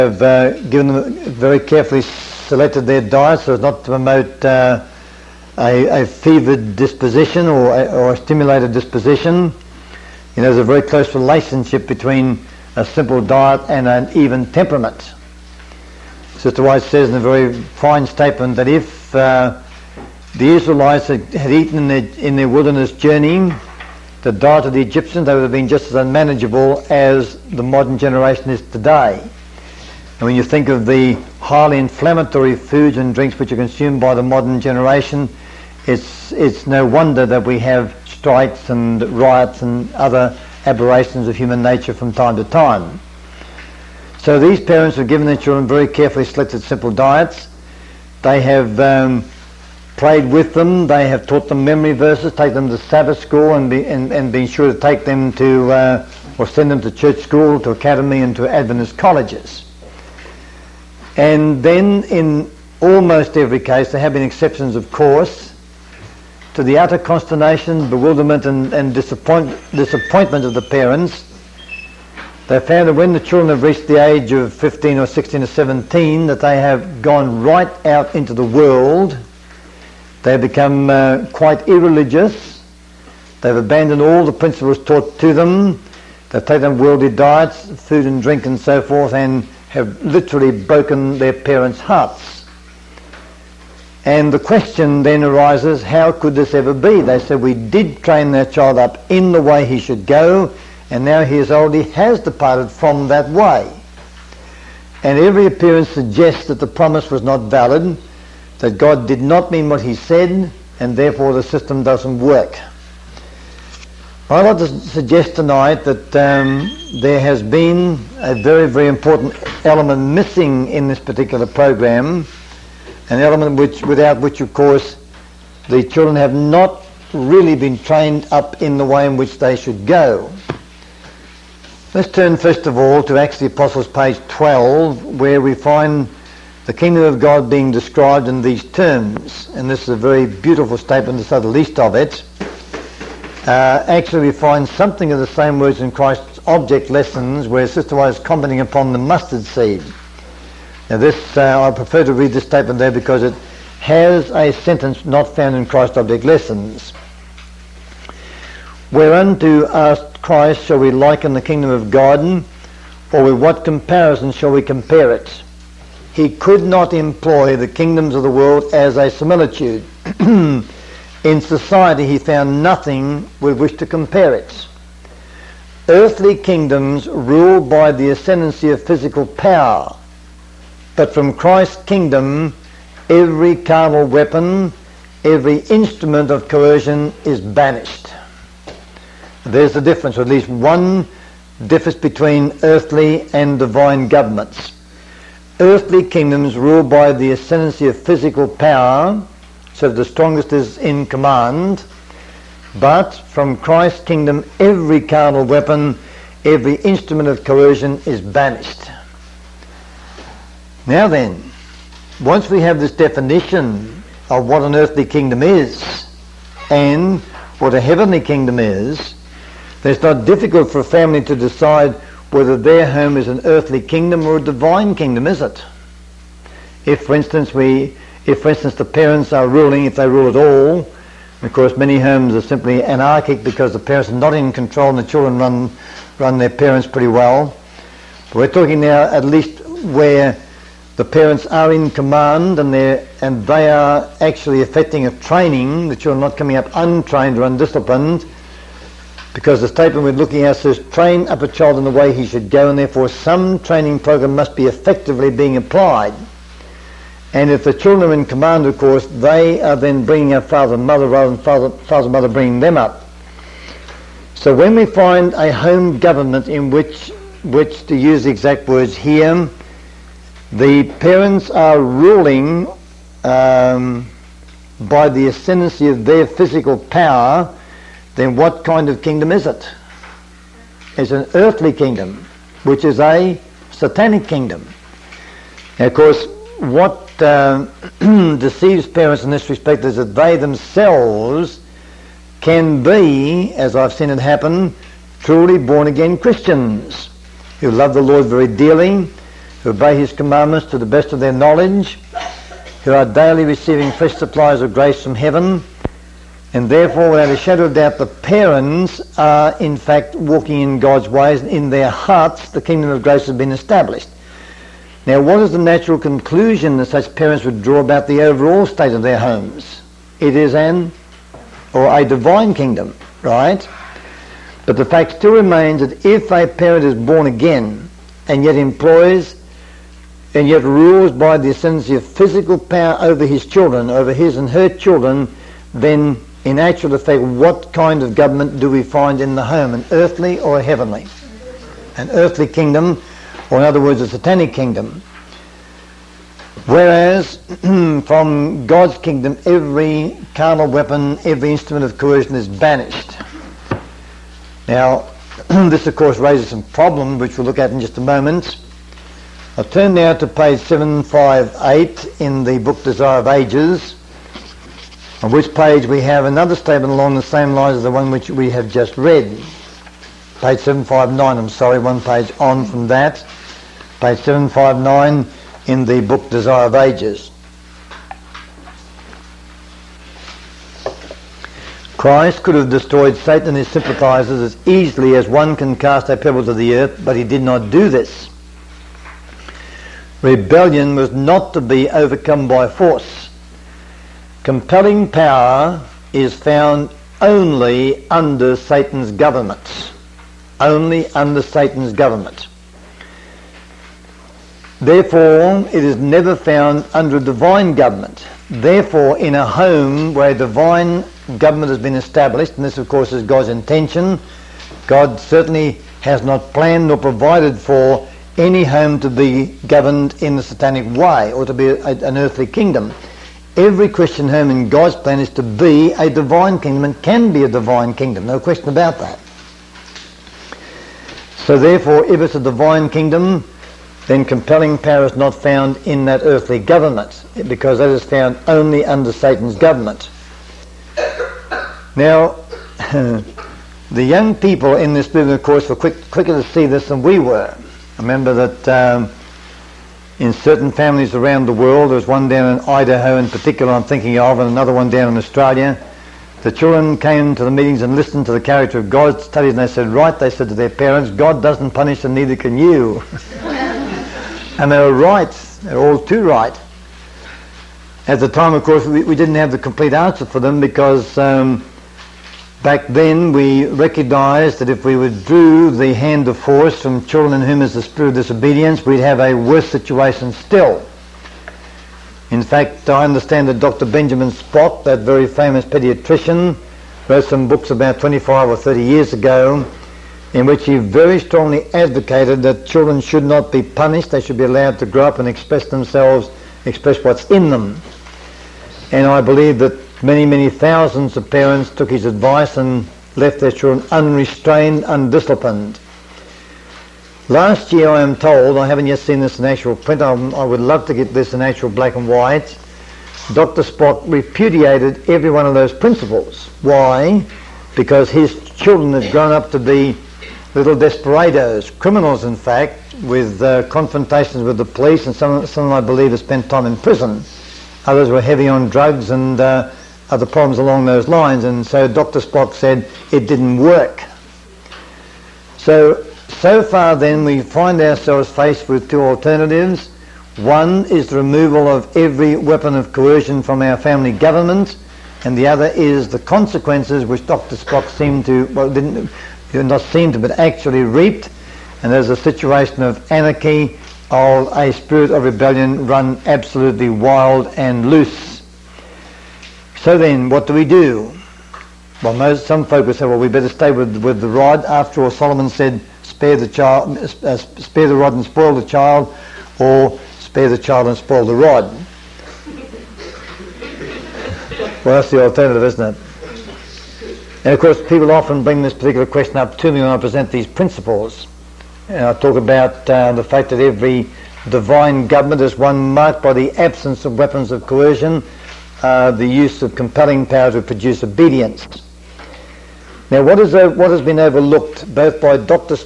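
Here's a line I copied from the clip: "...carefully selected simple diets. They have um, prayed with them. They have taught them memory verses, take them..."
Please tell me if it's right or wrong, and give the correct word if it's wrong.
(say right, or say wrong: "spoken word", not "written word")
right.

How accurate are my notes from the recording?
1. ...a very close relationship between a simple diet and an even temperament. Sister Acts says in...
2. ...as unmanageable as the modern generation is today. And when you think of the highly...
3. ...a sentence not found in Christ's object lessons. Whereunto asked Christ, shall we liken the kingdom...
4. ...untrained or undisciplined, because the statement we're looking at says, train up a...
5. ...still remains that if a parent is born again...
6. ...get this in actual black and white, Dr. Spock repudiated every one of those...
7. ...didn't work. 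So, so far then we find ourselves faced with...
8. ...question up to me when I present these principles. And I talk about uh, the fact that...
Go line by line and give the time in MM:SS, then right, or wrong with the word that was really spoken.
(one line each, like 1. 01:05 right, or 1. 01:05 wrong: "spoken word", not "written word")
1. 00:10 wrong: "White", not "Acts"
2. 00:25 right
3. 02:34 right
4. 04:06 right
5. 05:25 right
6. 08:30 right
7. 08:53 right
8. 09:39 right.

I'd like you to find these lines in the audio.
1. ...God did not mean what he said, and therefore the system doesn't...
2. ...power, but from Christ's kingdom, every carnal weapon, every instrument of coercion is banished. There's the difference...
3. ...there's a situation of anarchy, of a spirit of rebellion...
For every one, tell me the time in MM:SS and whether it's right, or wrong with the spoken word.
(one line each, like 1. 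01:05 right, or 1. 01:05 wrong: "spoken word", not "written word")
1. 01:48 right
2. 02:59 right
3. 09:11 right.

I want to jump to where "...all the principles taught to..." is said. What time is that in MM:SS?
01:24.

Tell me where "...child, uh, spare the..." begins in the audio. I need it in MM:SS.
09:26.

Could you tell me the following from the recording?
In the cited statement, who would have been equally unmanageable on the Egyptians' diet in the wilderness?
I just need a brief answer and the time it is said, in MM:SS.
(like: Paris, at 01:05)
The Israelites, at 00:20.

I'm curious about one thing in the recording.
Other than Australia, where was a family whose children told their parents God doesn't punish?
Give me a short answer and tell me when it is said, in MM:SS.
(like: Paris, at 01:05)
Idaho, at 07:32.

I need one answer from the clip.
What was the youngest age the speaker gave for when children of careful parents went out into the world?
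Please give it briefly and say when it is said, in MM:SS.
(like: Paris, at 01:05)
15, at 01:14.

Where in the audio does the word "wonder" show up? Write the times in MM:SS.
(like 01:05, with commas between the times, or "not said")
00:36.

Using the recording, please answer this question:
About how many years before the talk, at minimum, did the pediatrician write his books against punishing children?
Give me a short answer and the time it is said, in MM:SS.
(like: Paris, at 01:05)
25, at 08:07.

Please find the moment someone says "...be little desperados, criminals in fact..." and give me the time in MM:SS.
08:39.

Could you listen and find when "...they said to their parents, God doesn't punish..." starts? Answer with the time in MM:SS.
07:40.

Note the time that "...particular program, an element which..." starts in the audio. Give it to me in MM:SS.
02:00.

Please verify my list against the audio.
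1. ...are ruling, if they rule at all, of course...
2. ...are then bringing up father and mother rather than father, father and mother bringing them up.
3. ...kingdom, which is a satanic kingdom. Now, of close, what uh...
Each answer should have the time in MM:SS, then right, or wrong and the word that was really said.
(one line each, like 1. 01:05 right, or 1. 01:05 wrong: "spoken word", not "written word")
1. 03:49 right
2. 04:19 right
3. 04:41 wrong: "course", not "close".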